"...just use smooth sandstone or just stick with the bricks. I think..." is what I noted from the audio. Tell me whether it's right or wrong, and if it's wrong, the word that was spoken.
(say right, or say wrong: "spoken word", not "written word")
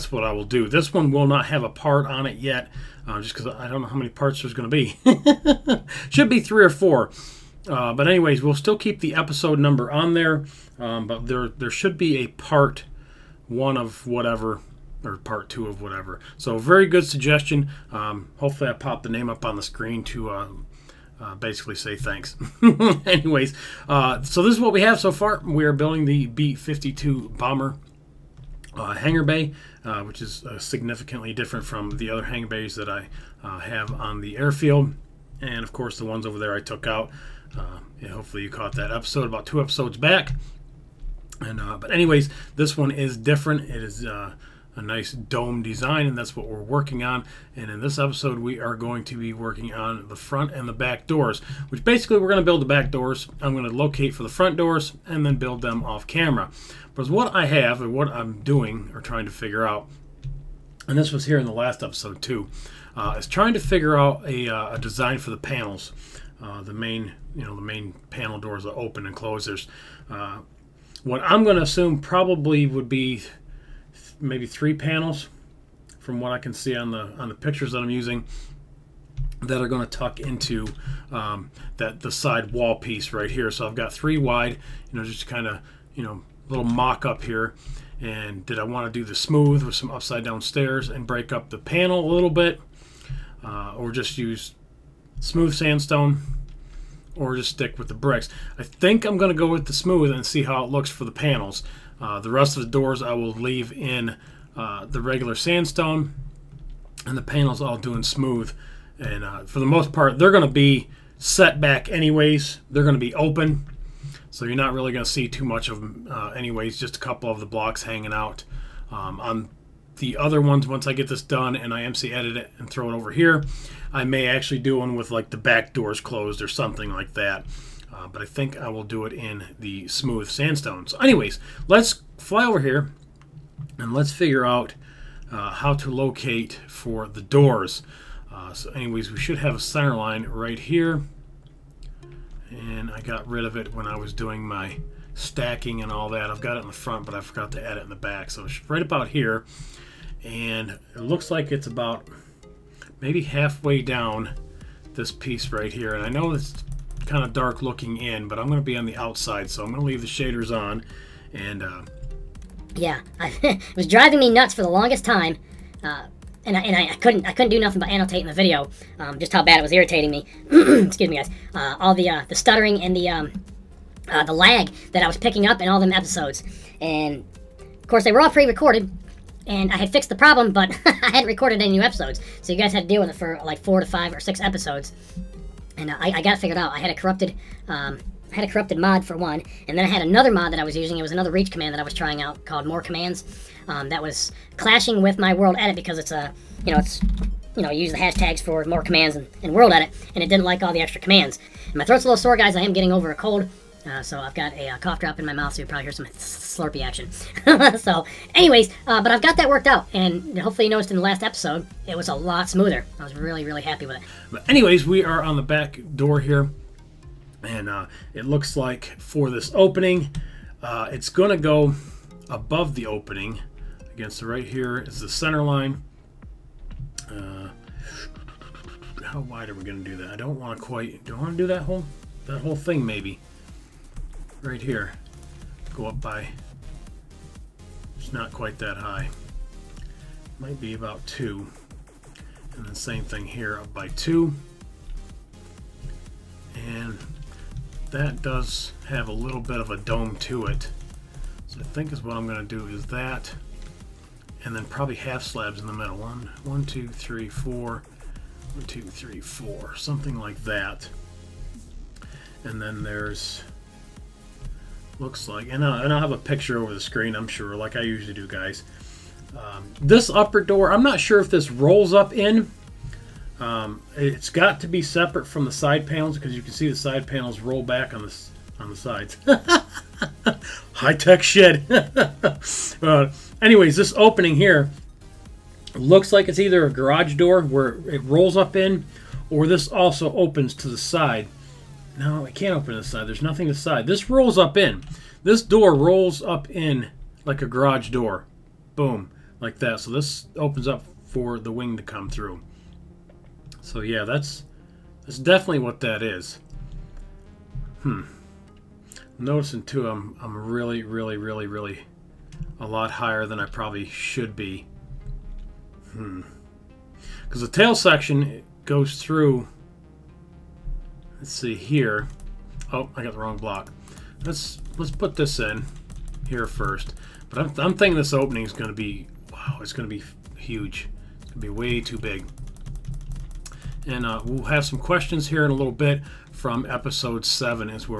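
right.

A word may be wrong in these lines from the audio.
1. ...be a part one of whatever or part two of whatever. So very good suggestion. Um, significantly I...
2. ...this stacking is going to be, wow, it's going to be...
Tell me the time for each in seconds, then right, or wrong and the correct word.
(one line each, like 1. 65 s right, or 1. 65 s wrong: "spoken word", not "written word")
1. 11 s wrong: "hopefully", not "significantly"
2. 327 s wrong: "opening", not "stacking".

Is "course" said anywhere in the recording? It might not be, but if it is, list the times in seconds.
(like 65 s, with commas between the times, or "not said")
35 s, 177 s.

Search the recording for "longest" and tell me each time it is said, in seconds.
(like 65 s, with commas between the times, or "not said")
164 s.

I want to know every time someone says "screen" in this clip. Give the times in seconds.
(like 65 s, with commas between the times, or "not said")
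19 s, 266 s.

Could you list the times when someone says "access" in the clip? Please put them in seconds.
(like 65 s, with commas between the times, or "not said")
not said.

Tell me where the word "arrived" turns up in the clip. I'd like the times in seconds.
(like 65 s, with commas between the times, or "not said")
not said.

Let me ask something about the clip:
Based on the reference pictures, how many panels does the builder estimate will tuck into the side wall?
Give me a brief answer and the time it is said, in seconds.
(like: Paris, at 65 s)
3, at 74 s.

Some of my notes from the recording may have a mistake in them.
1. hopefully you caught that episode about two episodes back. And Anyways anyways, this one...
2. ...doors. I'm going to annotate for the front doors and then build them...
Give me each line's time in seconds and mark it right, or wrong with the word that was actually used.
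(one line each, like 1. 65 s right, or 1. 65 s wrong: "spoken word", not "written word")
1. 38 s wrong: "But", not "Anyways"
2. 52 s wrong: "locate", not "annotate".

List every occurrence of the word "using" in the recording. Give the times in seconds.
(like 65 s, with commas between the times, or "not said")
77 s, 190 s.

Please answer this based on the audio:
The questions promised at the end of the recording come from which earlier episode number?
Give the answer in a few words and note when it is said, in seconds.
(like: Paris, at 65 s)
7, at 336 s.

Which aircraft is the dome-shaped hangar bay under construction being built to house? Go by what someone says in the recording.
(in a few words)
B-52 bomber.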